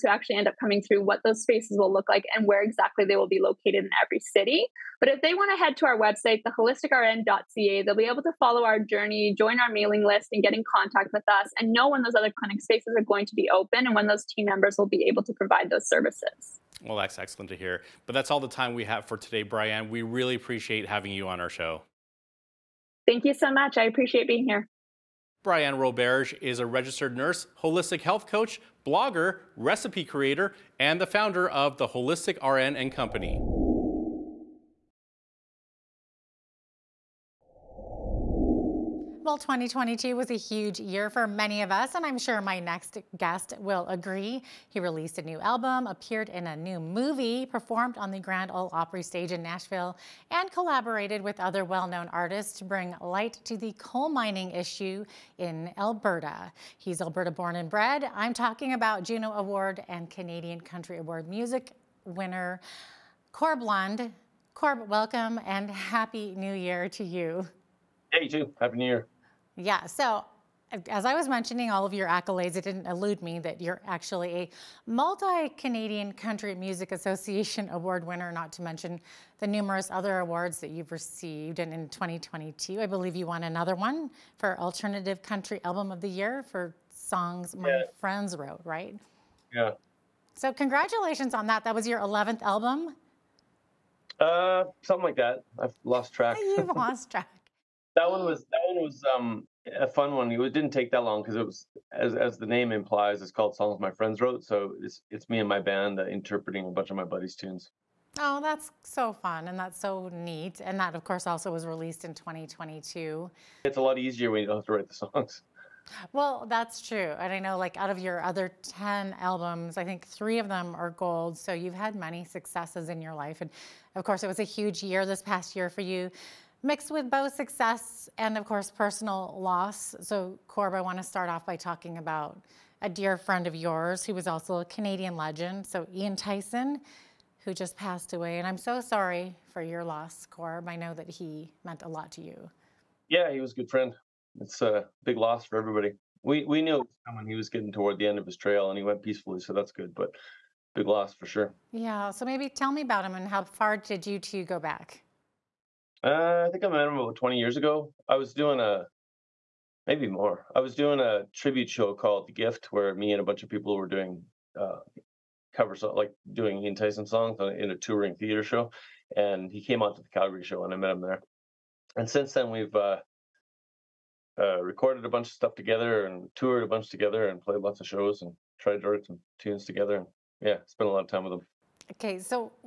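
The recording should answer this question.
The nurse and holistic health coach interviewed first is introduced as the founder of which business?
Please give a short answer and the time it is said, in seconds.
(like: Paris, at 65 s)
The Holistic RN and Company, at 31 s.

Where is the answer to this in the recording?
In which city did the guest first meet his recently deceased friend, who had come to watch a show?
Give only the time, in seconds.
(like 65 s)
170 s.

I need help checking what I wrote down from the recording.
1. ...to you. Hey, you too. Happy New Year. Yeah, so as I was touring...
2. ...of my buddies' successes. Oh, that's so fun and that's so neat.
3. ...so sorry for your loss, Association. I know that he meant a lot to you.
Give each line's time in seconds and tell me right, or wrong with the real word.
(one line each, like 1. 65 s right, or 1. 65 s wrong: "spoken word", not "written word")
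1. 66 s wrong: "mentioning", not "touring"
2. 106 s wrong: "tunes", not "successes"
3. 138 s wrong: "Corb", not "Association".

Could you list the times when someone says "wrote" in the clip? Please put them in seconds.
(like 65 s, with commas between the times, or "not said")
88 s, 104 s.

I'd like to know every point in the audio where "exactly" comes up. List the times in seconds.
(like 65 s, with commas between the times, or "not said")
2 s.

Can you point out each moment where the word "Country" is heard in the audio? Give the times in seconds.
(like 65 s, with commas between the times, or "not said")
60 s, 76 s, 85 s.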